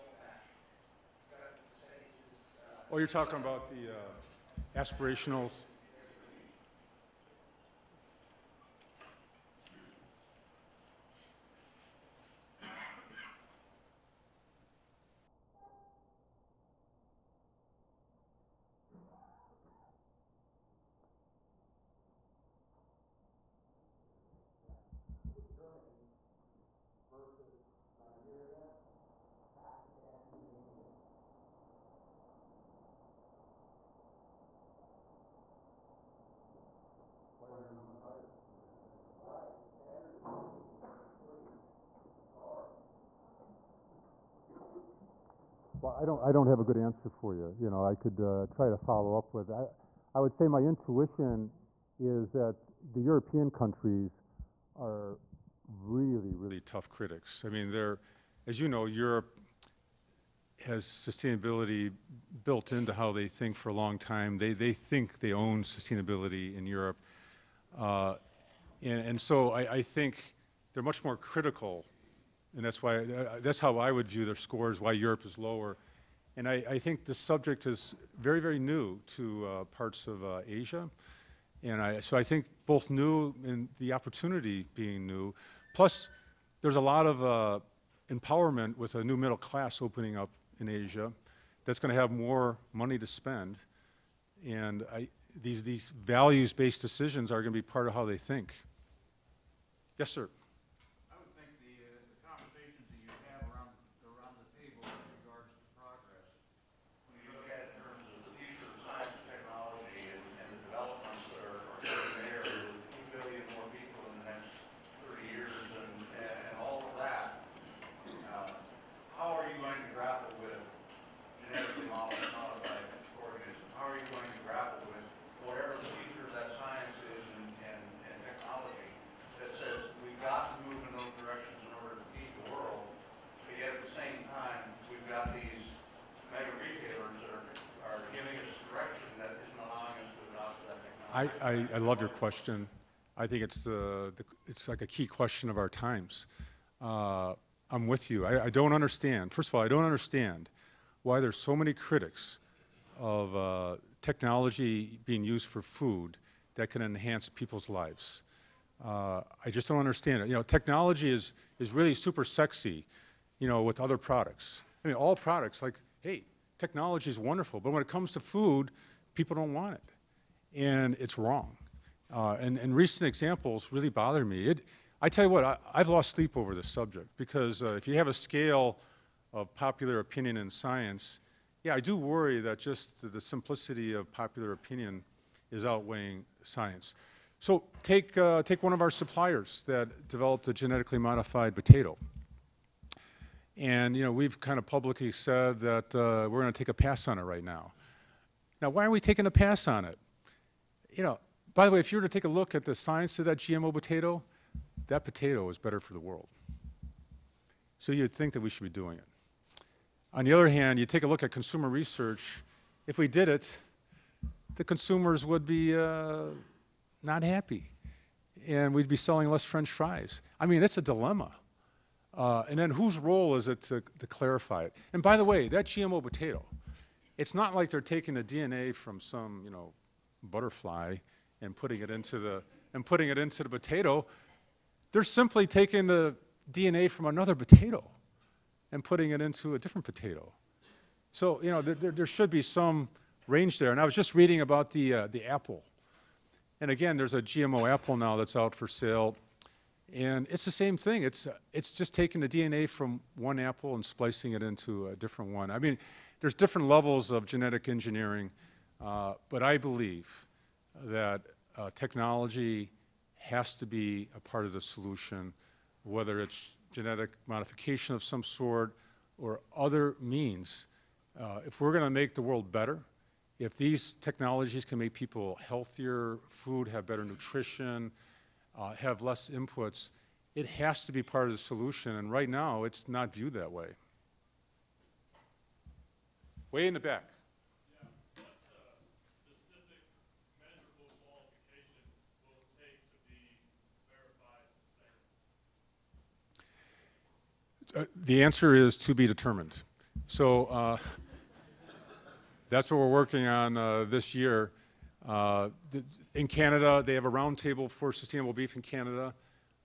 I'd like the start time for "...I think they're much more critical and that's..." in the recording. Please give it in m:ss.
1:09.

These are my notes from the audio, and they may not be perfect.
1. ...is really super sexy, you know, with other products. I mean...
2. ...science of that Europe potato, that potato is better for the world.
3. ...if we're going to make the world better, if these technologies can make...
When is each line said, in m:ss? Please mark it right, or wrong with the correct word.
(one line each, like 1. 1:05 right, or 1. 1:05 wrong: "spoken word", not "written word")
1. 2:41 right
2. 3:22 wrong: "GMO", not "Europe"
3. 4:31 right.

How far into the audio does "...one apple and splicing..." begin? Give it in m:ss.
4:13.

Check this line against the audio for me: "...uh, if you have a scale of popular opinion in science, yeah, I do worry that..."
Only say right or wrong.
right.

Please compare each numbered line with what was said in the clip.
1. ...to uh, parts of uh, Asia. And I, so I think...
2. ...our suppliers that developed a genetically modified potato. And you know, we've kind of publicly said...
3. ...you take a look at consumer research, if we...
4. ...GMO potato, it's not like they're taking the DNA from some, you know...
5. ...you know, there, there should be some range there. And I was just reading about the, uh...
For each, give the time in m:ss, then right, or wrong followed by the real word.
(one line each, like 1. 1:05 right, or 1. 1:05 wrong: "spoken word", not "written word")
1. 1:19 right
2. 3:08 right
3. 3:30 right
4. 3:45 right
5. 4:01 right.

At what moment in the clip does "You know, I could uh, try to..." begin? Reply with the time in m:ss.
0:47.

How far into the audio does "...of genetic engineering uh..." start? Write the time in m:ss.
4:17.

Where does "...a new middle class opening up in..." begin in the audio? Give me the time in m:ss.
1:28.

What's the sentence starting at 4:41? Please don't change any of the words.
And right now, it's not viewed that way.